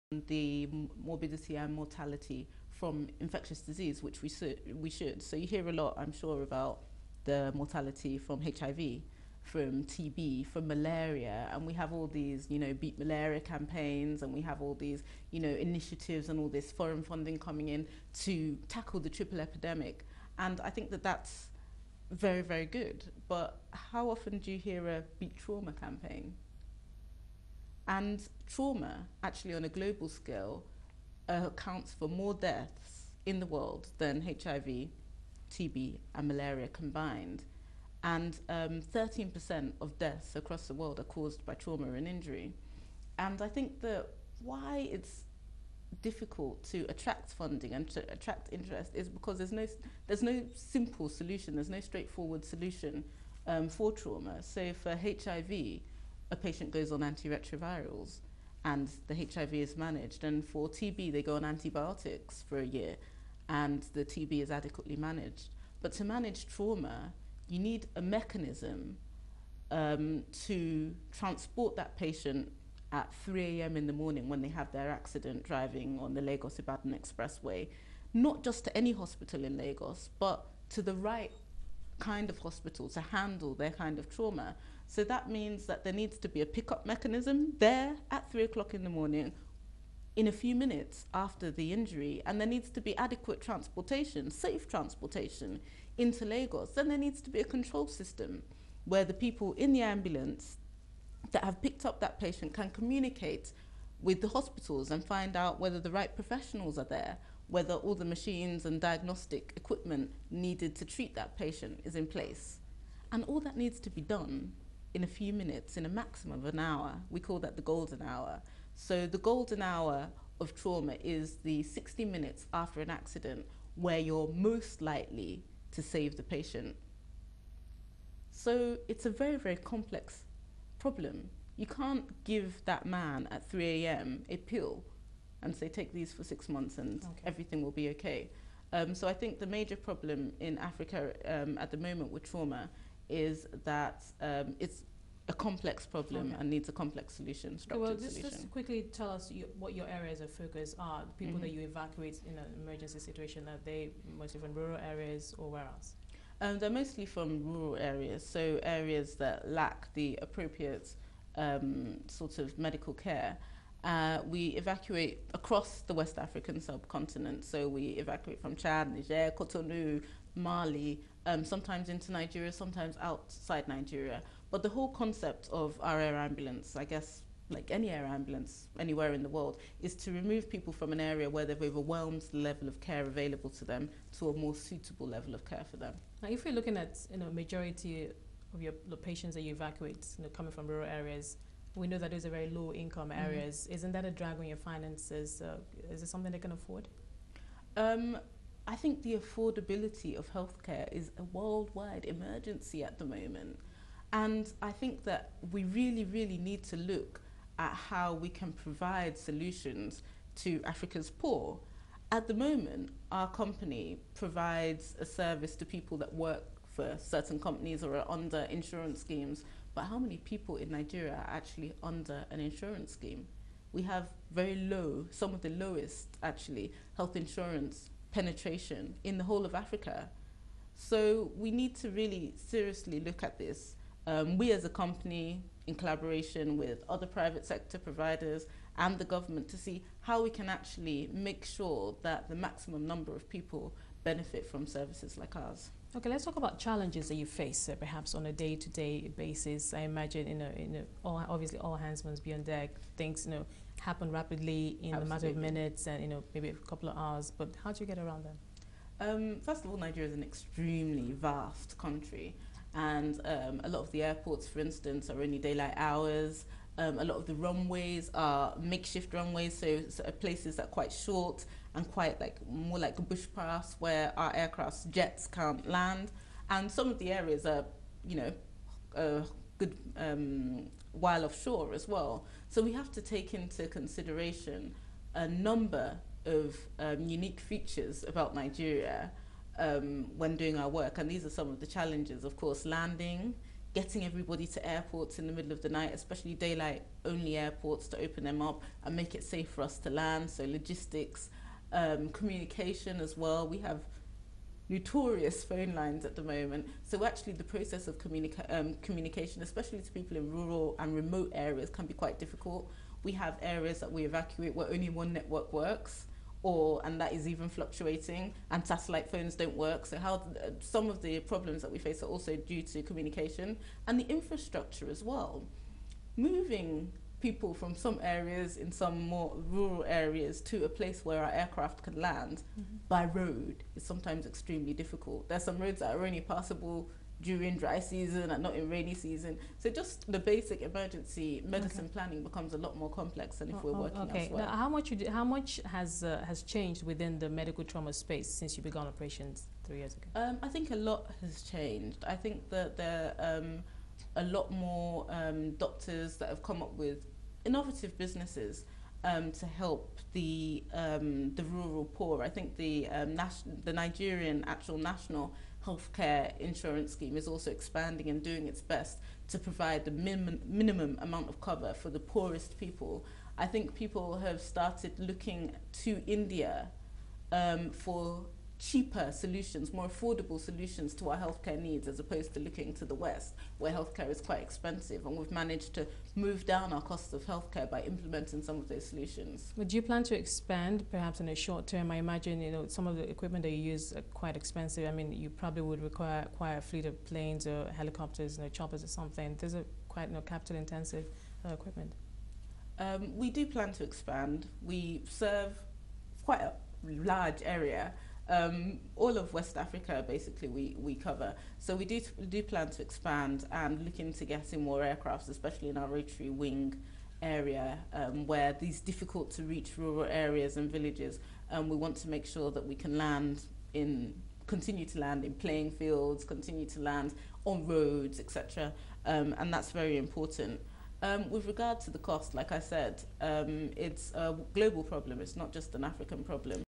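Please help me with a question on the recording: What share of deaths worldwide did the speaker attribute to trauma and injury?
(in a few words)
13%.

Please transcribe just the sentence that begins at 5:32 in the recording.
by road is sometimes extremely difficult there's some roads that are only passable during dry season and not in rainy season.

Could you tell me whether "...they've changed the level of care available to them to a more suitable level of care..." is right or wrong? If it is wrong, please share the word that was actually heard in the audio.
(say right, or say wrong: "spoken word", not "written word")
wrong: "overwhelmed", not "changed".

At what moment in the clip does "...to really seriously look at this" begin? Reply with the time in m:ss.
3:51.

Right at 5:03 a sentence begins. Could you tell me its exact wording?
We have notorious phone lines at the moment.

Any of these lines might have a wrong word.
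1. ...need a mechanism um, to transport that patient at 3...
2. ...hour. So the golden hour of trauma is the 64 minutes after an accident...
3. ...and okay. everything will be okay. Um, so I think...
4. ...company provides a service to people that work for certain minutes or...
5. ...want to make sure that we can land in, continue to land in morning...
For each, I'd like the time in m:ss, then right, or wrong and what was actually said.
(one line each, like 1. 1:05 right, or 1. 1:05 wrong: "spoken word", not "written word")
1. 1:07 right
2. 1:58 wrong: "60", not "64"
3. 2:16 right
4. 3:33 wrong: "companies", not "minutes"
5. 7:01 wrong: "playing", not "morning".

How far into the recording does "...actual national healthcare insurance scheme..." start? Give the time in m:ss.
6:04.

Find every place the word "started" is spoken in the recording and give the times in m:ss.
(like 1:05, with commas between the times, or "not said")
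6:14.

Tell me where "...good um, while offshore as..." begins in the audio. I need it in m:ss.
4:39.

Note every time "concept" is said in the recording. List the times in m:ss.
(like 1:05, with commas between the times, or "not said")
2:54.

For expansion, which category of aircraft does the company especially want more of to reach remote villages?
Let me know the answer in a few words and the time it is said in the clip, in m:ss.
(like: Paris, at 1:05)
Rotary wing, at 6:55.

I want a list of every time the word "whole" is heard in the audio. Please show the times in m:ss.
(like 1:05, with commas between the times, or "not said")
2:54, 3:49.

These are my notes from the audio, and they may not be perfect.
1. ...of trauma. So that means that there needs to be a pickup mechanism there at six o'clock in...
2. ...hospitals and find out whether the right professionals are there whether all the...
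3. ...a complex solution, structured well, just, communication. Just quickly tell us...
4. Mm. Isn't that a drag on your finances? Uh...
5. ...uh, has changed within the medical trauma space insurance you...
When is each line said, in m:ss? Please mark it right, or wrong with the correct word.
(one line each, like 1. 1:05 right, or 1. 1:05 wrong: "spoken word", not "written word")
1. 1:23 wrong: "three", not "six"
2. 1:44 right
3. 2:26 wrong: "solution", not "communication"
4. 3:13 right
5. 5:46 wrong: "since", not "insurance".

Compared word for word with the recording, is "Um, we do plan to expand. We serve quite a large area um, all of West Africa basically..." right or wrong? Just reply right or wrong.
right.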